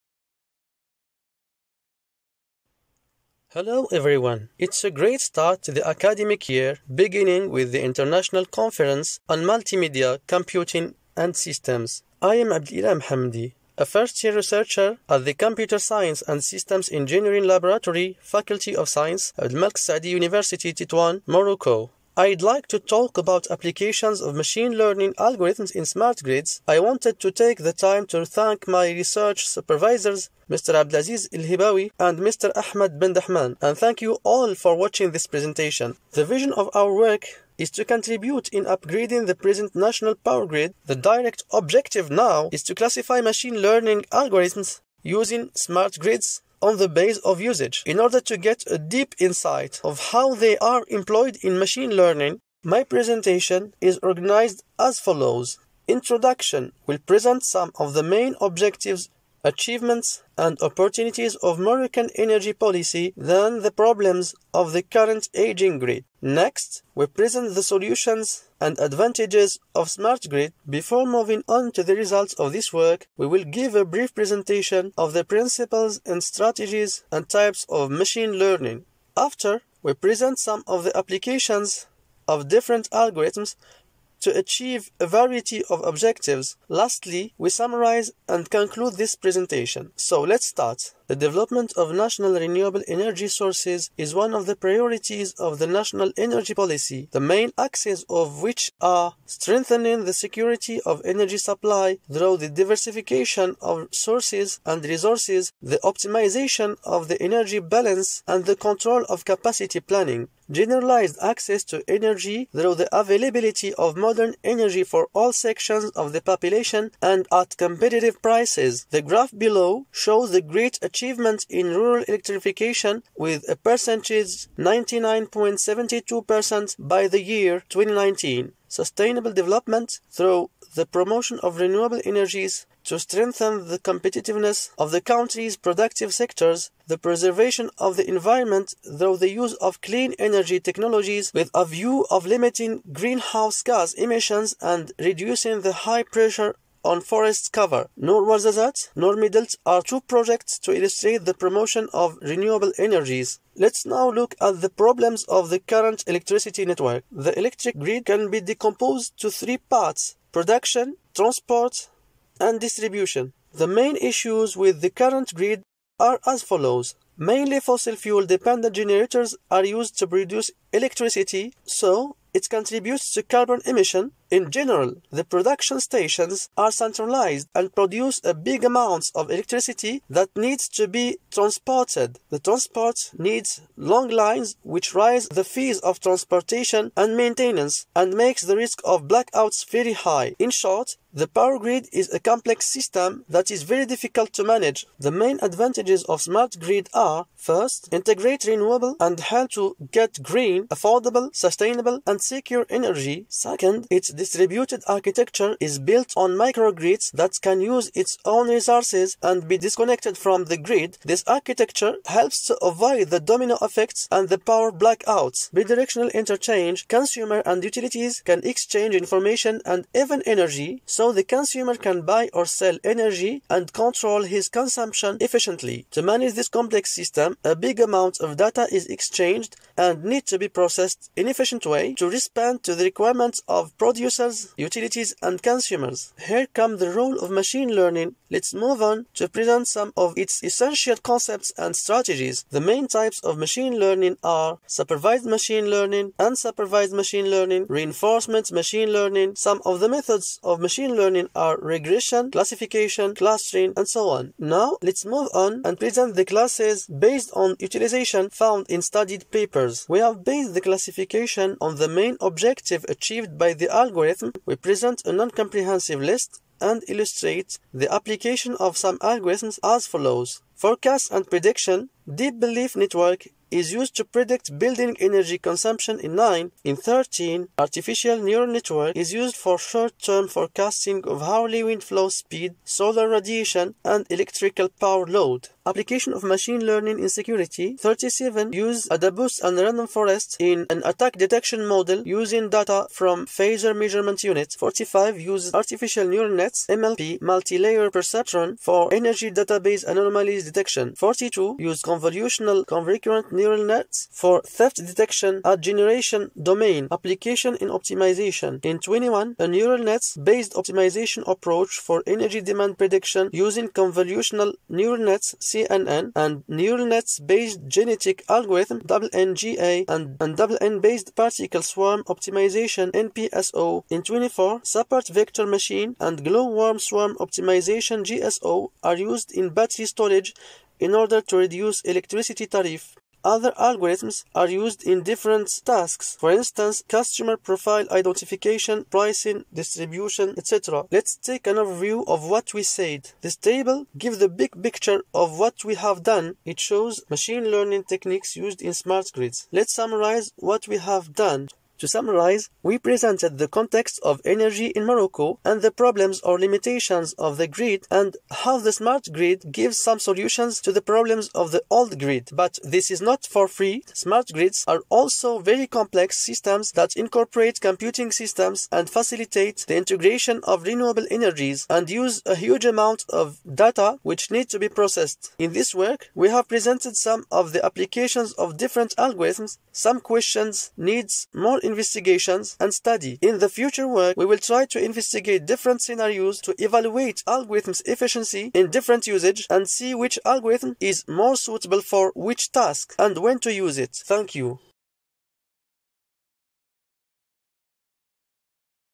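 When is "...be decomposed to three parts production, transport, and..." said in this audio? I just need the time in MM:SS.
02:38.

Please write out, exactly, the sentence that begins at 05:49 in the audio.
Let's summarize what we have done.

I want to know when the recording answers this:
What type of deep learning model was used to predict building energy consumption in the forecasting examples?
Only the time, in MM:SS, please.
04:32.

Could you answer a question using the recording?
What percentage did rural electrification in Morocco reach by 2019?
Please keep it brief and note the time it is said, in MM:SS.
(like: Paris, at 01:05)
99.72%, at 02:04.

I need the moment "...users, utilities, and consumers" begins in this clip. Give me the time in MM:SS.
03:54.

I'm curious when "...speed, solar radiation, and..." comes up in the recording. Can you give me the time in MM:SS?
04:42.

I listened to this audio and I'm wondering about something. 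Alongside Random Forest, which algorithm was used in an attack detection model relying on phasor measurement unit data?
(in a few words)
AdaBoost.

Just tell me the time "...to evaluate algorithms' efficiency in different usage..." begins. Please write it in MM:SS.
06:26.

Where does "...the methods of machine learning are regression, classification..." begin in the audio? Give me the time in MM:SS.
04:09.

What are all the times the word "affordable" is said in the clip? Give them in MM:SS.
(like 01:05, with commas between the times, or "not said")
03:20.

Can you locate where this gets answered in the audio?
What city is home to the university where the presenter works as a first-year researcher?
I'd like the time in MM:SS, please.
00:20.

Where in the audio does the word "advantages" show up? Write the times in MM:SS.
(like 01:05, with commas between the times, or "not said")
01:08, 03:15.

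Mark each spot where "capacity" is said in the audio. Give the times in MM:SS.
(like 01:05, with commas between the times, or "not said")
01:49.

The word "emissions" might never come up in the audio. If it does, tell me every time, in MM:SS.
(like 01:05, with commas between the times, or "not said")
02:23, 02:53.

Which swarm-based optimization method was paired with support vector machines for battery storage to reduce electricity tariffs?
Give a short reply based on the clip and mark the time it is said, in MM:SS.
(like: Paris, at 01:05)
Glowworm swarm optimization, at 05:26.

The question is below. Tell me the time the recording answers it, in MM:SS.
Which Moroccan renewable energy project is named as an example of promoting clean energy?
02:28.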